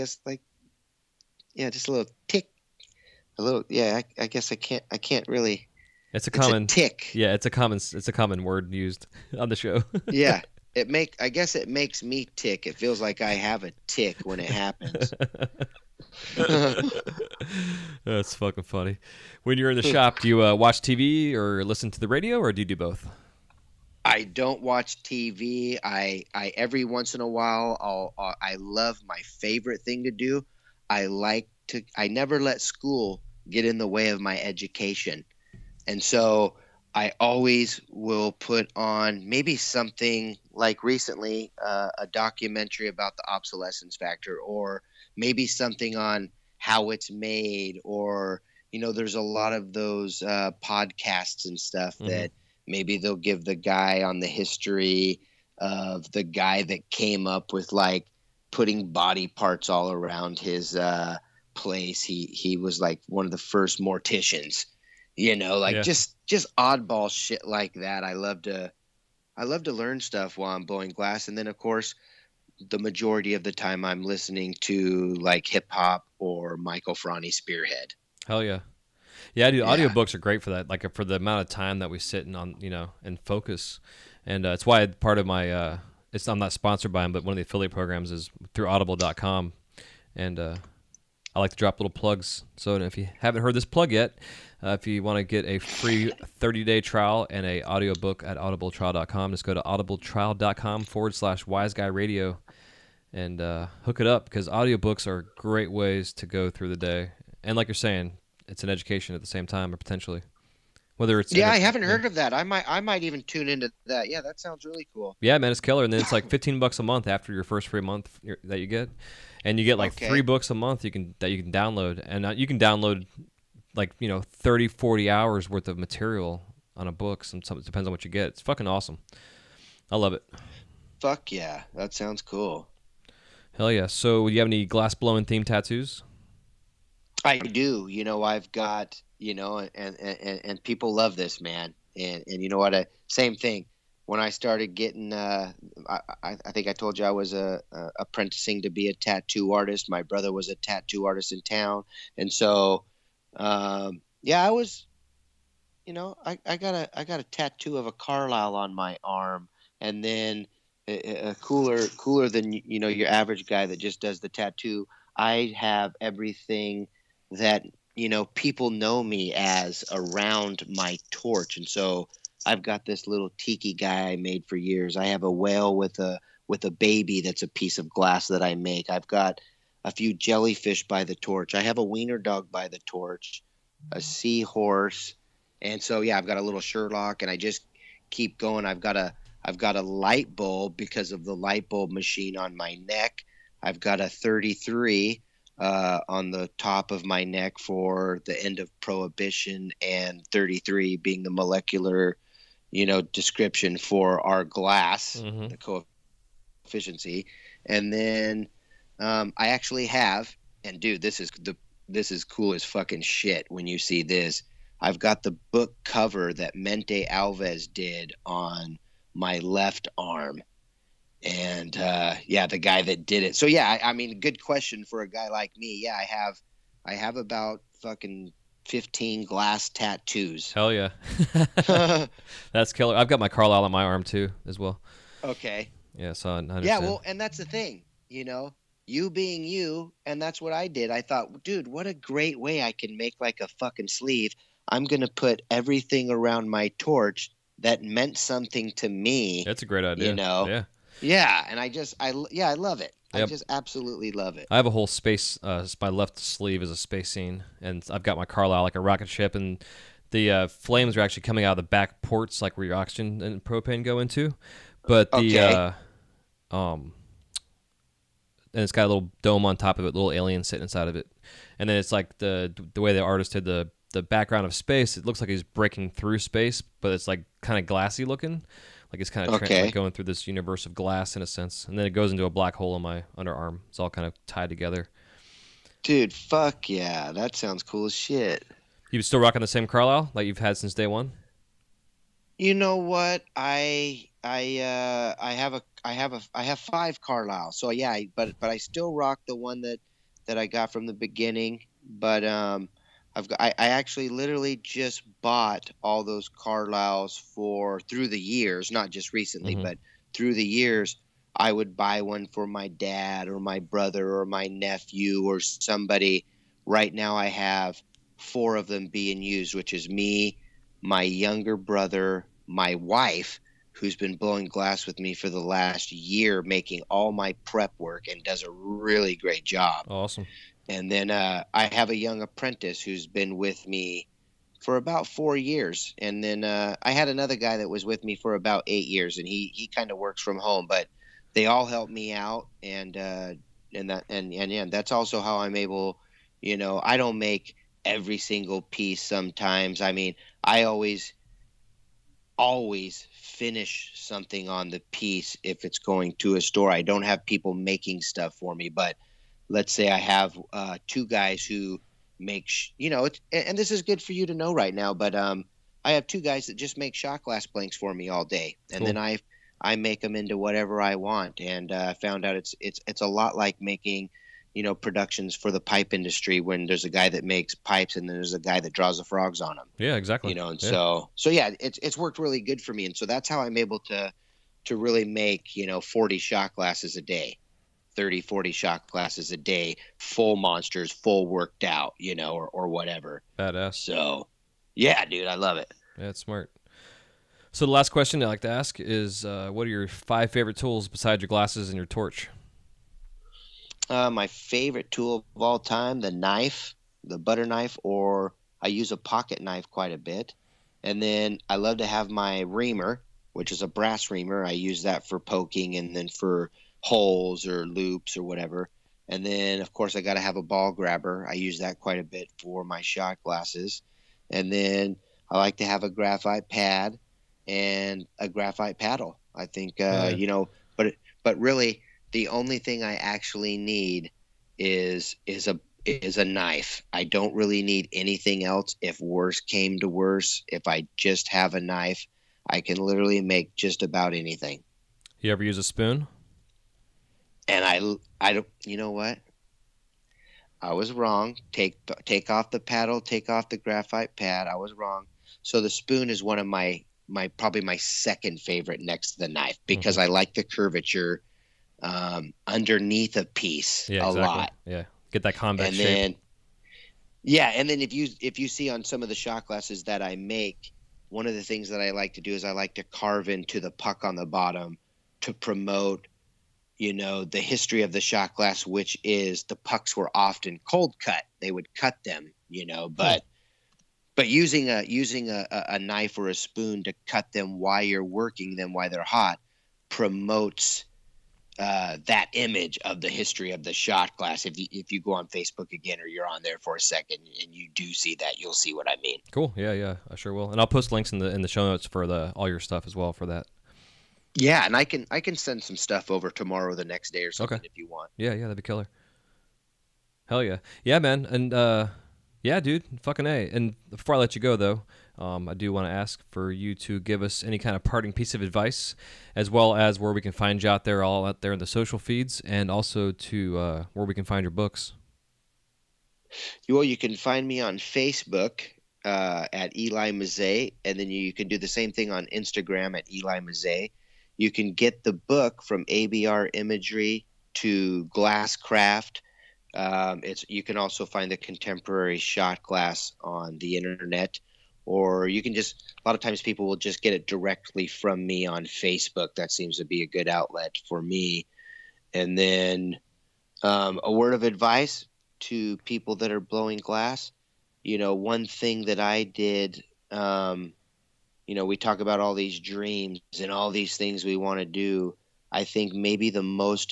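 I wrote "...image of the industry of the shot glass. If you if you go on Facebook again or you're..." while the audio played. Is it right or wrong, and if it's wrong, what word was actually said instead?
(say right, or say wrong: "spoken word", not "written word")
wrong: "history", not "industry".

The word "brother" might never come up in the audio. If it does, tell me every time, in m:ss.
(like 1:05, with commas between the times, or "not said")
2:30, 5:13, 5:21.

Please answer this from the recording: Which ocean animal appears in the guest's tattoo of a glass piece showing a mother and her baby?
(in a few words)
whale.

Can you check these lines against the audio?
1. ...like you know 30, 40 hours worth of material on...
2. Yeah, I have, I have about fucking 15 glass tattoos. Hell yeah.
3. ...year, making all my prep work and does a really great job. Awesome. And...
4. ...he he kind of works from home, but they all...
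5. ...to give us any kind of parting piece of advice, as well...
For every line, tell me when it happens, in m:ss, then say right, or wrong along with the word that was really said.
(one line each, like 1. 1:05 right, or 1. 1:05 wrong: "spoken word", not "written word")
1. 2:03 right
2. 3:45 right
3. 5:25 right
4. 5:39 right
5. 8:36 right.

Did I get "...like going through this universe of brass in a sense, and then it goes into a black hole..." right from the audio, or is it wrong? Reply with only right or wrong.
wrong.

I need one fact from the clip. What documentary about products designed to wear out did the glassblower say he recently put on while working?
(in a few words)
obsolescence factor.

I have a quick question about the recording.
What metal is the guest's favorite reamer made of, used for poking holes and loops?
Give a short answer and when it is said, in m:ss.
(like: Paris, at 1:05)
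brass, at 6:53.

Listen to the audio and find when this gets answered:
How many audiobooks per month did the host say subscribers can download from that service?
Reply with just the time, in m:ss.
2:00.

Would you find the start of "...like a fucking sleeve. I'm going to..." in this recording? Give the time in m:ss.
4:03.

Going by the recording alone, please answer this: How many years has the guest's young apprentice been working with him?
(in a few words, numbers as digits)
4.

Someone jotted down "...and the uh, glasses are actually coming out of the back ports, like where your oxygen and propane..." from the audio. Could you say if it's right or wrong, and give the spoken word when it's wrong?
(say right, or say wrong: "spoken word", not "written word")
wrong: "flames", not "glasses".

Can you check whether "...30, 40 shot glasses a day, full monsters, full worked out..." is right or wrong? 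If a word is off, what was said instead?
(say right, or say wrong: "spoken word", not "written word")
right.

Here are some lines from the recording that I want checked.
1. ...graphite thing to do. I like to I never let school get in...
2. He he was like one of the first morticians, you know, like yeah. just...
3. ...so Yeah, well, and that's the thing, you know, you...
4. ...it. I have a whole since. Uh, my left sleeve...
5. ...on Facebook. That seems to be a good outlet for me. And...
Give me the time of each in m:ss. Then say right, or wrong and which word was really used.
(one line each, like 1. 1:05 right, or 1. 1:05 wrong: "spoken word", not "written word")
1. 0:29 wrong: "favorite", not "graphite"
2. 1:02 right
3. 3:56 right
4. 4:14 wrong: "space", not "since"
5. 9:08 right.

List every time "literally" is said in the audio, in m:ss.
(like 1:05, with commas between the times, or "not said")
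5:04, 7:22.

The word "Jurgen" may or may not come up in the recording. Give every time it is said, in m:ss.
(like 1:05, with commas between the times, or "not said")
not said.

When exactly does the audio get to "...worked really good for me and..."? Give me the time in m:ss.
6:21.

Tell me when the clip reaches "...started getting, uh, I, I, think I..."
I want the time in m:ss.
2:24.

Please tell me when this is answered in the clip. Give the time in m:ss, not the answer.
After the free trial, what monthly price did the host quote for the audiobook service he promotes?
1:56.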